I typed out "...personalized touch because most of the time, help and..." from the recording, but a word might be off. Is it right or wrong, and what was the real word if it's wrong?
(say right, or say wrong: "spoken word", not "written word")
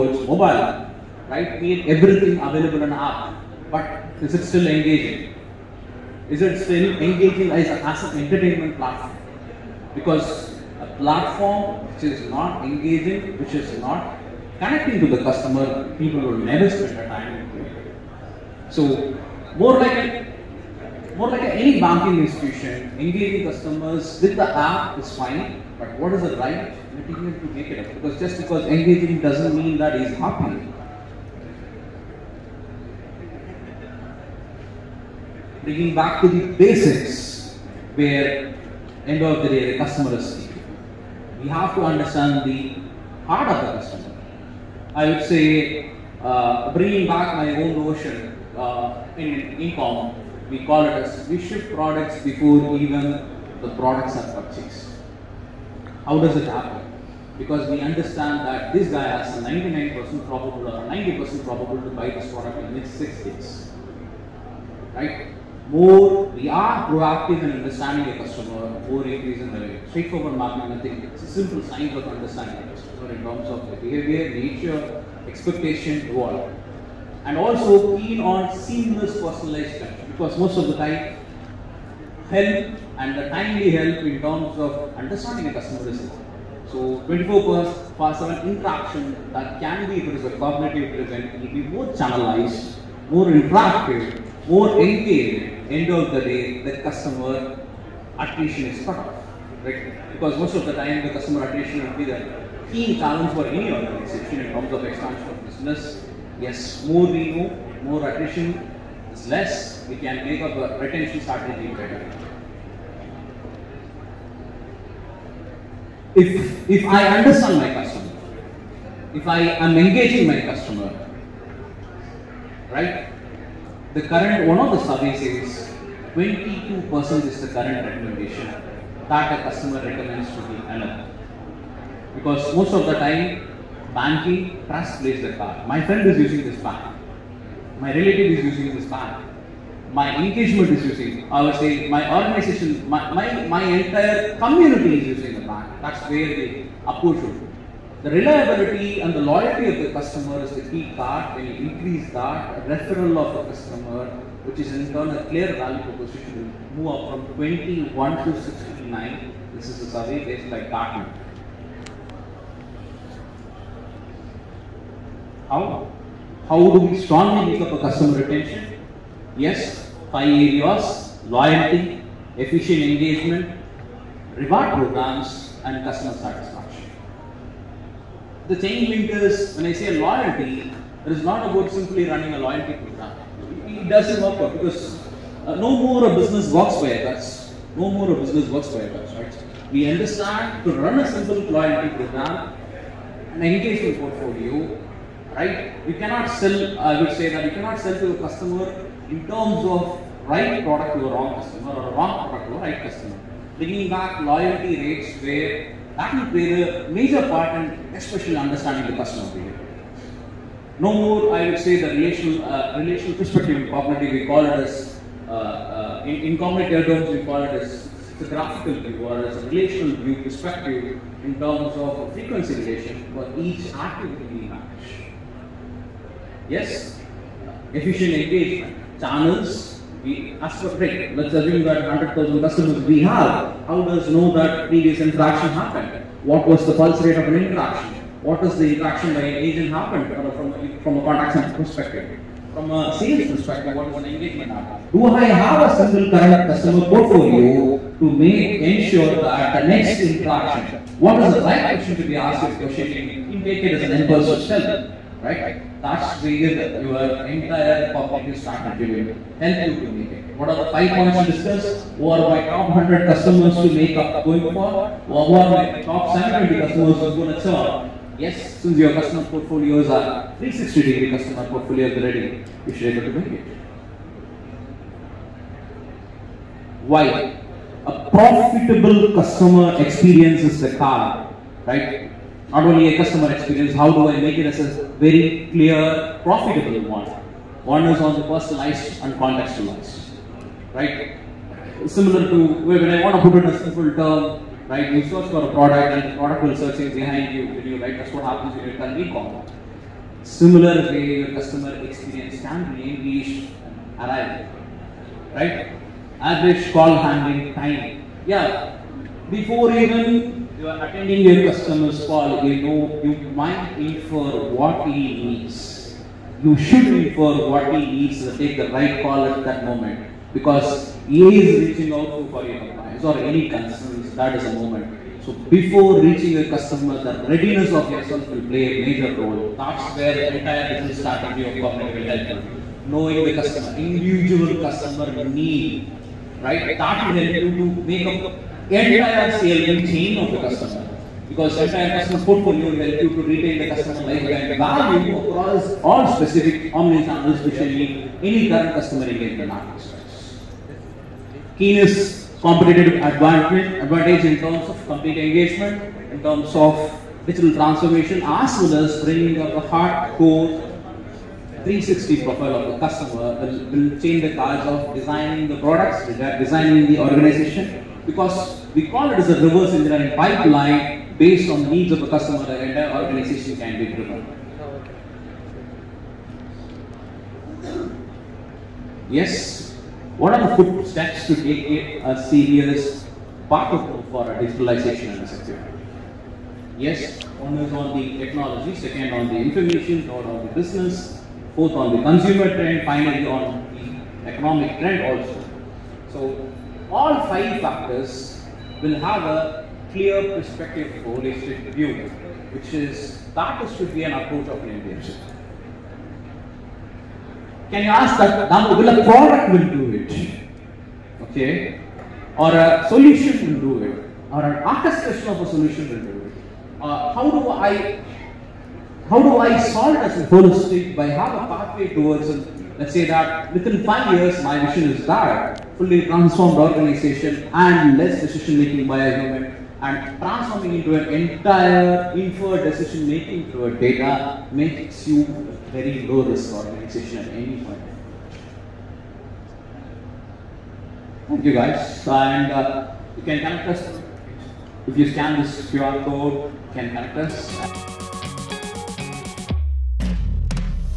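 right.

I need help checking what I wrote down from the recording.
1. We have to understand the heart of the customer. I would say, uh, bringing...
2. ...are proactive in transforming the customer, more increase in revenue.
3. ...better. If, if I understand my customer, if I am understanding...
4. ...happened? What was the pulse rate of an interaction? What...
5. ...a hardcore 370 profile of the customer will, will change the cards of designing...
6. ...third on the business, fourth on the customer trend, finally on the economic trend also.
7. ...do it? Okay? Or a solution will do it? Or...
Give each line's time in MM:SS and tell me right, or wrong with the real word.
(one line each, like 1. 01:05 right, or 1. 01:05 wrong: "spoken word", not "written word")
1. 00:41 right
2. 01:06 wrong: "understanding", not "transforming"
3. 01:51 wrong: "engaging", not "understanding"
4. 03:55 right
5. 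05:59 wrong: "360", not "370"
6. 06:30 wrong: "consumer", not "customer"
7. 06:49 right.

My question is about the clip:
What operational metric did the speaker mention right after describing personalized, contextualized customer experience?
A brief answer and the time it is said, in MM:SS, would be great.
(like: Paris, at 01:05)
Average call handling time, at 05:06.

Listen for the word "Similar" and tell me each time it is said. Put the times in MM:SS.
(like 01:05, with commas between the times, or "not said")
04:51, 05:00.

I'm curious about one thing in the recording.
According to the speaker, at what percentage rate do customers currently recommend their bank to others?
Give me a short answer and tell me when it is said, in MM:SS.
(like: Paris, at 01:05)
22%, at 02:06.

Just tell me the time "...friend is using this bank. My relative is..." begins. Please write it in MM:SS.
02:15.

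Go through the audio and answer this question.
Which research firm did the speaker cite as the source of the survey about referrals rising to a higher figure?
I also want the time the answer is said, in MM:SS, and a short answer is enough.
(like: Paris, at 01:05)
Gartner, at 02:40.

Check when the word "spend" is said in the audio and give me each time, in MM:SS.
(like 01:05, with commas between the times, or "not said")
00:16.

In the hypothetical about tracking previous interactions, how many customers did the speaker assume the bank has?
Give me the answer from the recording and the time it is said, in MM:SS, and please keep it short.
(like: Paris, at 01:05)
100,000, at 03:51.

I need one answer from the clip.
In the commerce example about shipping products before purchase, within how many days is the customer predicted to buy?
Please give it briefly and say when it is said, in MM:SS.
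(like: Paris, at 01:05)
6, at 01:02.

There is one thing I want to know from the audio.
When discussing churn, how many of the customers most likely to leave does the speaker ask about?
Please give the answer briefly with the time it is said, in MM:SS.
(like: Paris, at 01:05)
70, at 04:26.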